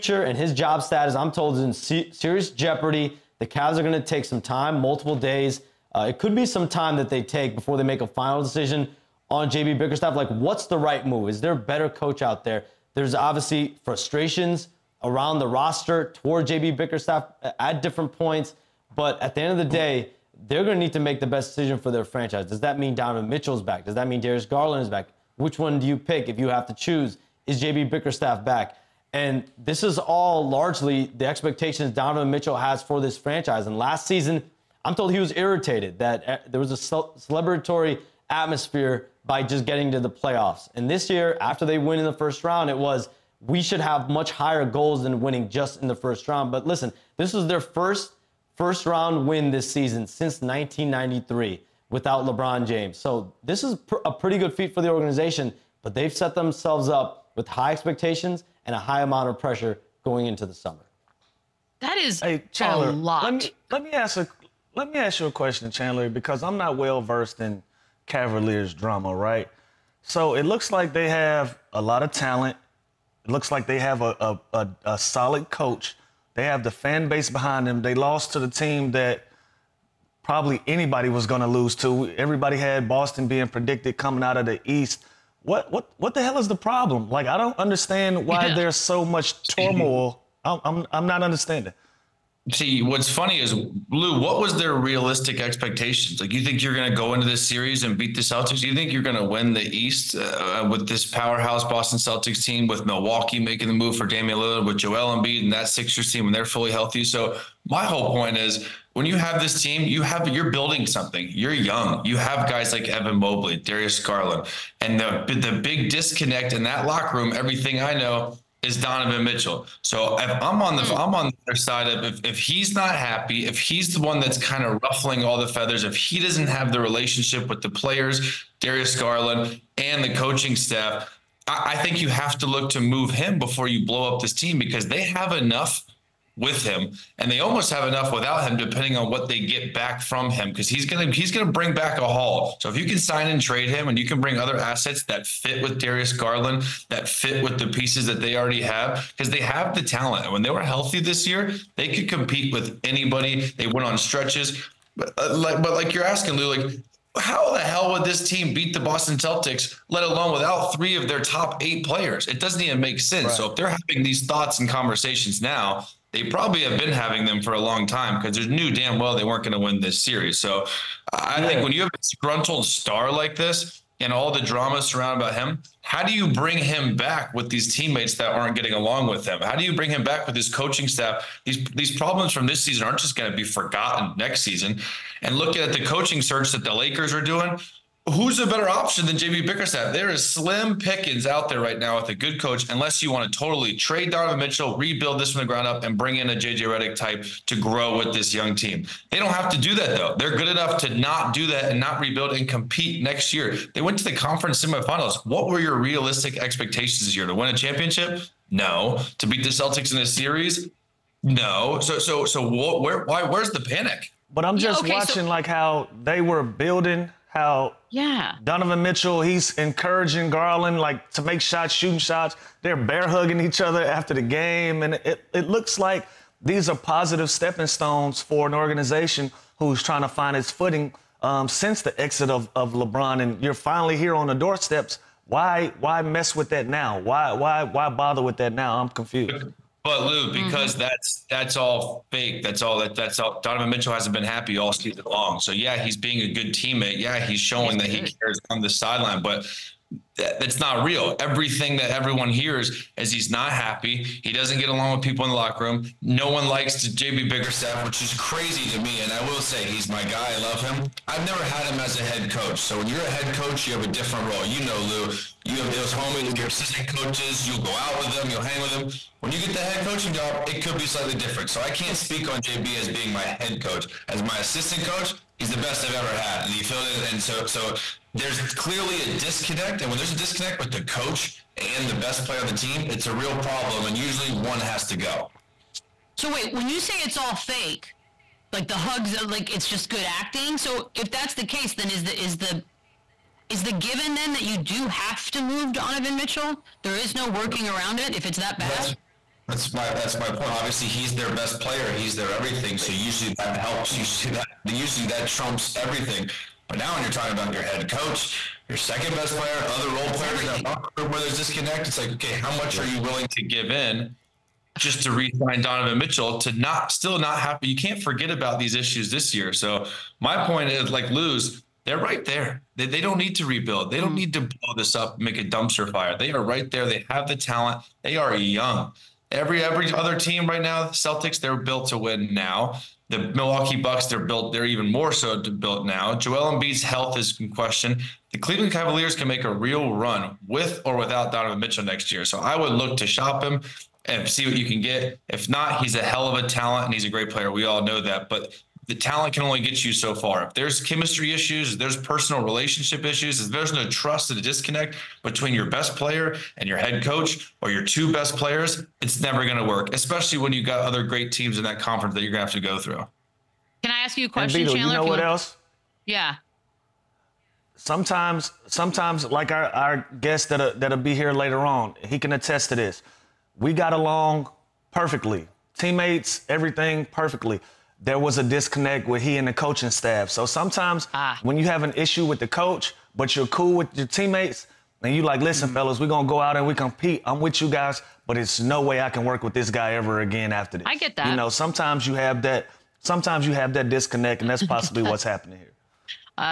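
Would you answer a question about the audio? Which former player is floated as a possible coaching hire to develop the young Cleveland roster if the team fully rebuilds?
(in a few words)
JJ Redick.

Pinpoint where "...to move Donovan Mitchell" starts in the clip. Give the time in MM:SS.
04:55.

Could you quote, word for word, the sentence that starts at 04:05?
So yeah, he's being a good teammate.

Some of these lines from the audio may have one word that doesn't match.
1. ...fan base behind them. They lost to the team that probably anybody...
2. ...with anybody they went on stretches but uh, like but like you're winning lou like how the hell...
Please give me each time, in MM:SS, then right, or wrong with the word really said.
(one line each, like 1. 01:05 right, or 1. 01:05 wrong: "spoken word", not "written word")
1. 01:16 right
2. 02:32 wrong: "asking", not "winning".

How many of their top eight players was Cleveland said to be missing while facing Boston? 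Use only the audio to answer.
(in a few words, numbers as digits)
3.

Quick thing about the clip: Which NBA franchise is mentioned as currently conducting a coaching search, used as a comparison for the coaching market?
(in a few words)
the Lakers.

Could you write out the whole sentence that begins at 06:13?
We got along perfectly, teammates, everything perfectly there was a disconnect with he and the coaching staff.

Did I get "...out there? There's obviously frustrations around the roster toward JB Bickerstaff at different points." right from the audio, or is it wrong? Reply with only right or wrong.
right.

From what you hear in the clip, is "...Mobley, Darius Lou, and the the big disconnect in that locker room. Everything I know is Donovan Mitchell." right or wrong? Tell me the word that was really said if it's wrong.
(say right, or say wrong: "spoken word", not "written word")
wrong: "Garland", not "Lou".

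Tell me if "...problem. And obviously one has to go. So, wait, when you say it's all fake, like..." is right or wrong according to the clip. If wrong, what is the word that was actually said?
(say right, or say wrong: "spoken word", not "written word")
wrong: "usually", not "obviously".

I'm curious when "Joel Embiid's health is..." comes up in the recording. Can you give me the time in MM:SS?
05:36.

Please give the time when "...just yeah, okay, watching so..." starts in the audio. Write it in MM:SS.
03:34.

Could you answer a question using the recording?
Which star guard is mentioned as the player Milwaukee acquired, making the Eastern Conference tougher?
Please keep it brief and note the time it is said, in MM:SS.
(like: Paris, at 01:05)
Damian Lillard, at 01:44.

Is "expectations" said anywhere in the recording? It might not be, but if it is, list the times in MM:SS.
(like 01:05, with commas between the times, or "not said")
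00:31, 00:57, 01:35, 03:26.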